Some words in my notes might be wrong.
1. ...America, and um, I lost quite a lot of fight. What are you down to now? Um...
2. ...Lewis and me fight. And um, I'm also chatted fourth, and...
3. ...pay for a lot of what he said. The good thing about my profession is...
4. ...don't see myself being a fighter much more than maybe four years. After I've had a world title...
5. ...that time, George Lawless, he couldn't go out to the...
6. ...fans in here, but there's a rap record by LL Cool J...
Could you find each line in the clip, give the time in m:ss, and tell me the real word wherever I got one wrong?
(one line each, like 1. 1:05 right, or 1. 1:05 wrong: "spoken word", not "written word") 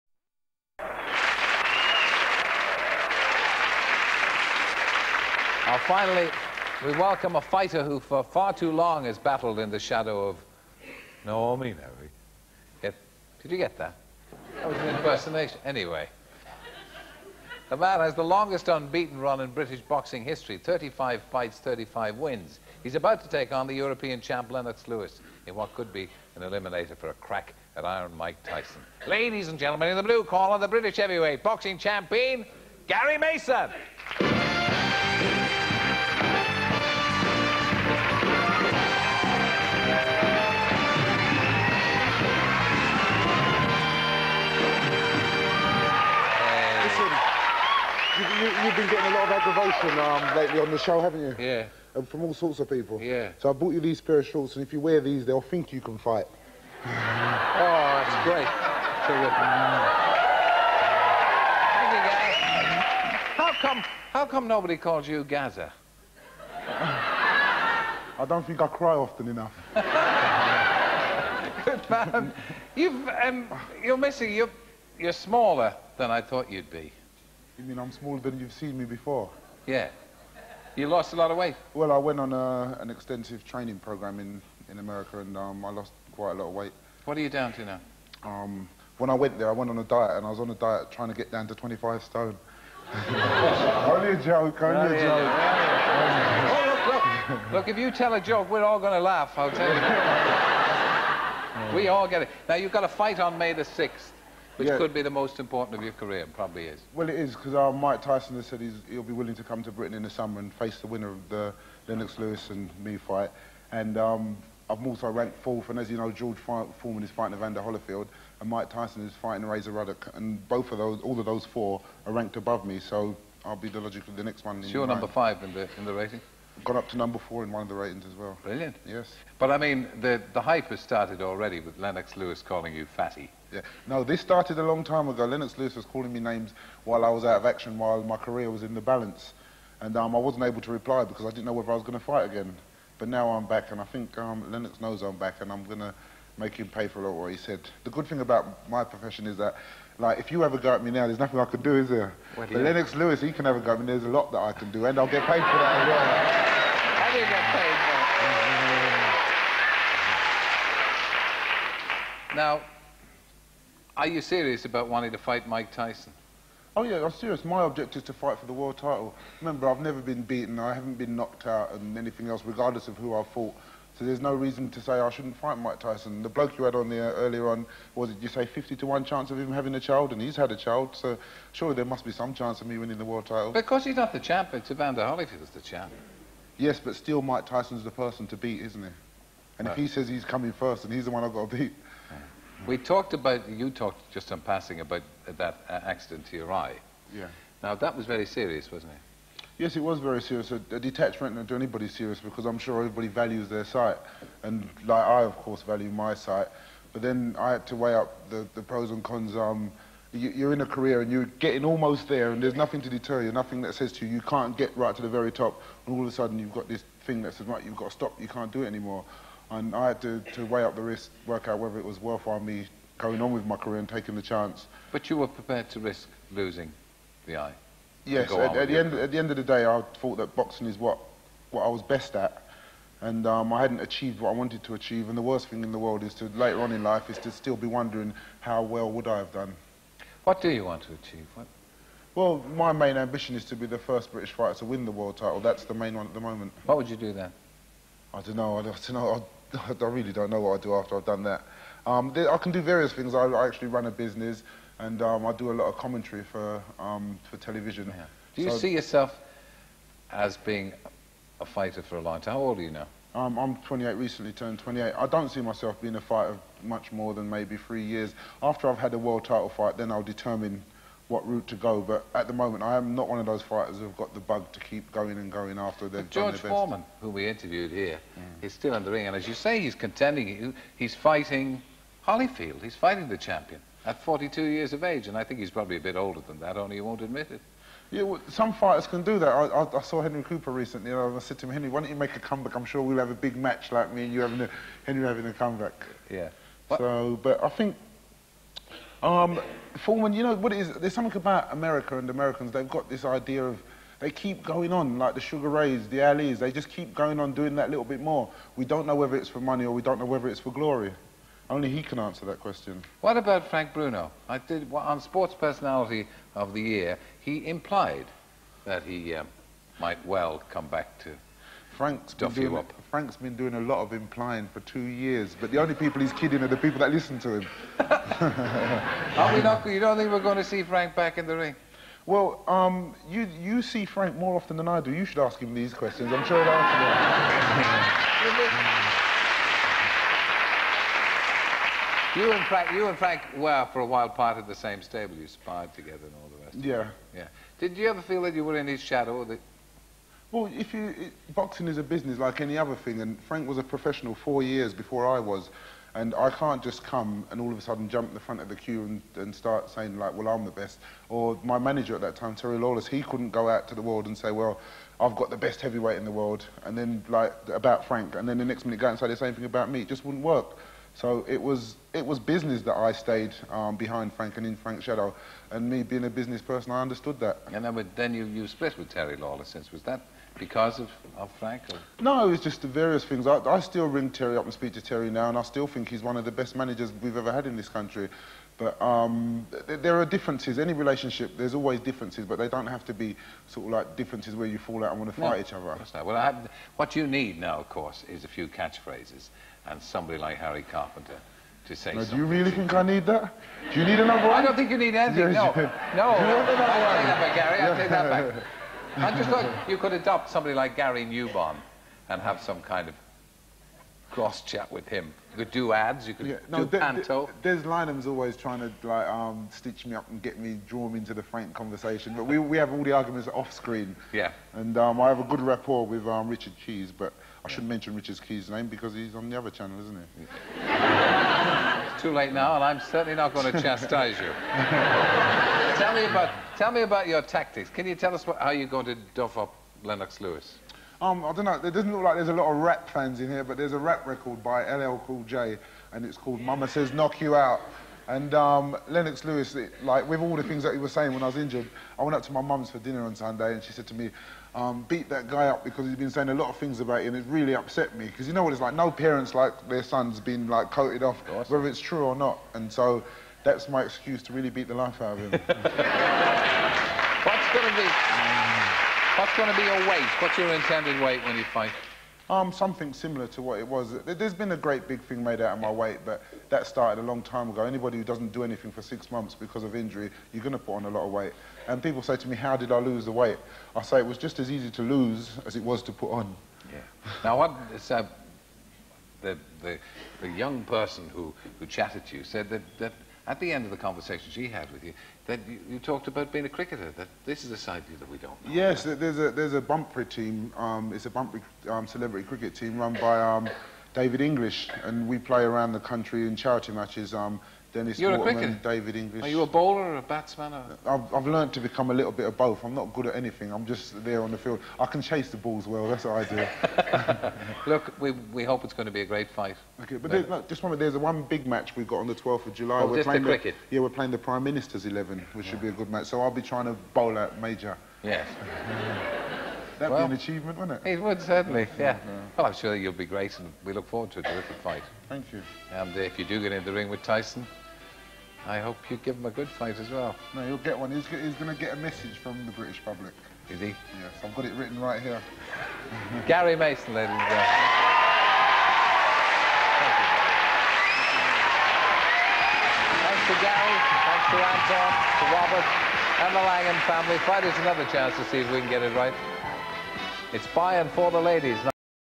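1. 1:24 wrong: "weight", not "fight"
2. 1:52 wrong: "ranked", not "chatted"
3. 2:26 right
4. 4:25 wrong: "three", not "four"
5. 6:02 wrong: "Terry", not "George"
6. 7:22 right.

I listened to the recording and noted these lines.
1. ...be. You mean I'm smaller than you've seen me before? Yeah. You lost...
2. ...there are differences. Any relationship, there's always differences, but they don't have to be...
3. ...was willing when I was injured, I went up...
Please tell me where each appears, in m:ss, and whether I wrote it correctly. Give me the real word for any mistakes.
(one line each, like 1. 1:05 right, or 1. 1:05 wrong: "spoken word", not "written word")
1. 1:16 right
2. 6:29 right
3. 7:30 wrong: "saying", not "willing".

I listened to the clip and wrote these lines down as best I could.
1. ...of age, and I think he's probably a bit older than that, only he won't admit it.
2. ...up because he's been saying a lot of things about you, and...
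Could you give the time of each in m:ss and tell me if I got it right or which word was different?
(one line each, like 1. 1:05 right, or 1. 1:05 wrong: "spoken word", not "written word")
1. 4:44 right
2. 7:35 right.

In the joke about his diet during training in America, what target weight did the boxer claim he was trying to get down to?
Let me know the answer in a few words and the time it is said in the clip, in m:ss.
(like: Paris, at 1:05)
25 stone, at 1:31.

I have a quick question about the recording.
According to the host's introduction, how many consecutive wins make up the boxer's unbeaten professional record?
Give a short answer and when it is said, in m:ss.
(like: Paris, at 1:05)
35, at 0:20.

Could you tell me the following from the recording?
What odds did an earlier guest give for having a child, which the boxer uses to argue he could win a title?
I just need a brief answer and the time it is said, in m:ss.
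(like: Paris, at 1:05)
50 to 1, at 2:58.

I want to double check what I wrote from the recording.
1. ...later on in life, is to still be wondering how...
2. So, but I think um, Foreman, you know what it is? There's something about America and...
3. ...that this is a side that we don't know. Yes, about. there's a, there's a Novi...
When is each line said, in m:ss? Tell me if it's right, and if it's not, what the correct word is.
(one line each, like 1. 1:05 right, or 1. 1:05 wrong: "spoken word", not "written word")
1. 3:56 right
2. 4:56 right
3. 8:16 wrong: "Bunbury", not "Novi".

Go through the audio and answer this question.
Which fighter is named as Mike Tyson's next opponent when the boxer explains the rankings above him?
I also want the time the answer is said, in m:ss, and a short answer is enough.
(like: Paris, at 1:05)
Razor Ruddock, at 1:59.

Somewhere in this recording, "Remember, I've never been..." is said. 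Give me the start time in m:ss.
2:49.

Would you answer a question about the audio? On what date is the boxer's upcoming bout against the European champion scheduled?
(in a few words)
May 6th.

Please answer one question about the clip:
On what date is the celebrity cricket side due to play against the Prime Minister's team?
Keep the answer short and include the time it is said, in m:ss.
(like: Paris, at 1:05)
12th of July, at 8:42.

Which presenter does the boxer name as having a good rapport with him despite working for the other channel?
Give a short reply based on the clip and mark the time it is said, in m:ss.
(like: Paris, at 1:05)
Richard Keys, at 7:06.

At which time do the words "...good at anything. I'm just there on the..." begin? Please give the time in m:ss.
8:32.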